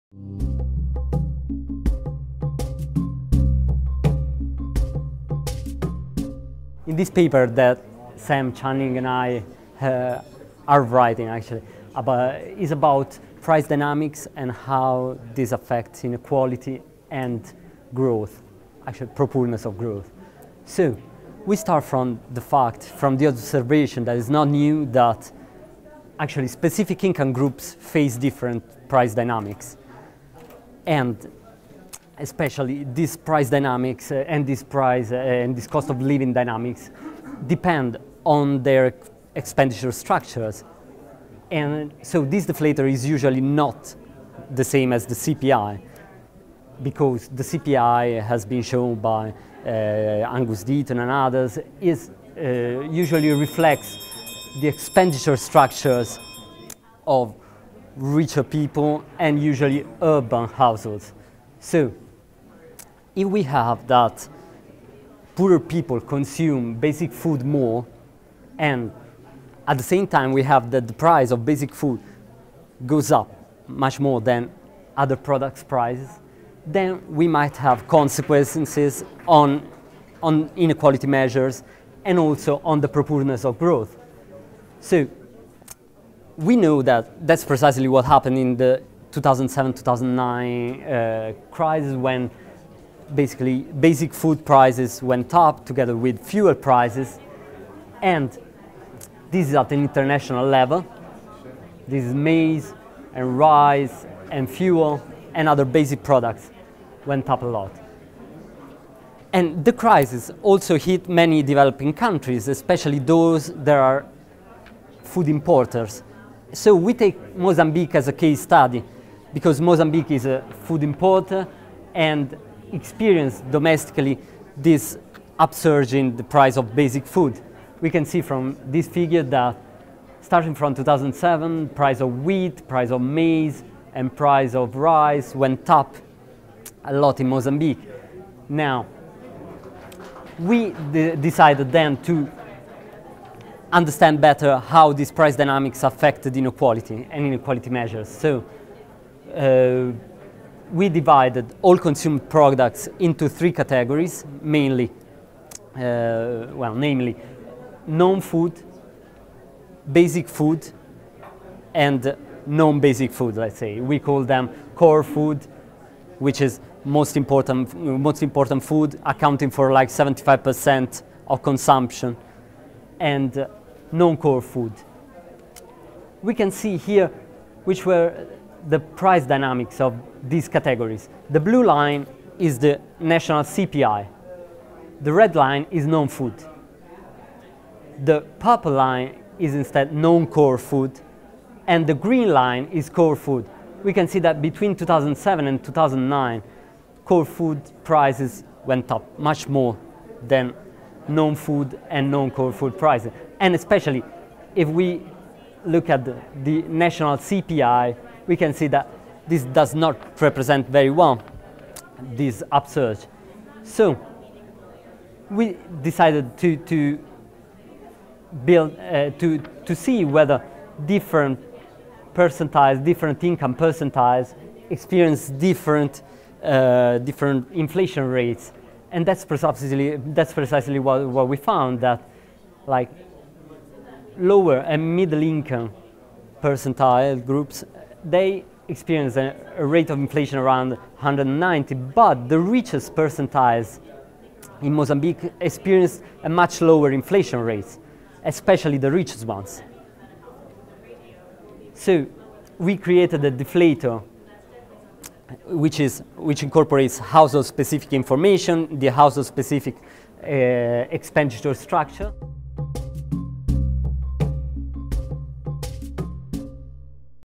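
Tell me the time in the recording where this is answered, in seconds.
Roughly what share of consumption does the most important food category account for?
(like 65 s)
169 s.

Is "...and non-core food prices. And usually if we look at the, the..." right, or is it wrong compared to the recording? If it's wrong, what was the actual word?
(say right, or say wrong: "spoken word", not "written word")
wrong: "especially", not "usually".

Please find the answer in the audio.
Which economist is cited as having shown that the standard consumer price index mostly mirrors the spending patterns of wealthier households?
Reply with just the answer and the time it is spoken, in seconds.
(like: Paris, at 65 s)
Angus Deaton, at 50 s.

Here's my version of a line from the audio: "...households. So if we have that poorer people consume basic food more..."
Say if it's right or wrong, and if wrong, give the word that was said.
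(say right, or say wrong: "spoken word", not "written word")
right.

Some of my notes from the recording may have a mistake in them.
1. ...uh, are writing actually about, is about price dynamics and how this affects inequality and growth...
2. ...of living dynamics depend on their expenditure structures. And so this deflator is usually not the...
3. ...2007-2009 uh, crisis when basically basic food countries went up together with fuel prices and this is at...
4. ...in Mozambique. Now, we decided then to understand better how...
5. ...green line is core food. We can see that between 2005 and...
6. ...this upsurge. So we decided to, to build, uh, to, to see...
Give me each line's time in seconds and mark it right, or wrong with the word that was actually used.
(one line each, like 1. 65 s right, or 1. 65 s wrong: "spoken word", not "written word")
1. 9 s right
2. 35 s right
3. 89 s wrong: "prices", not "countries"
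4. 137 s right
5. 191 s wrong: "2007", not "2005"
6. 212 s right.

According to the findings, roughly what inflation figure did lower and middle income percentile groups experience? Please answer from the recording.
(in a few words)
190.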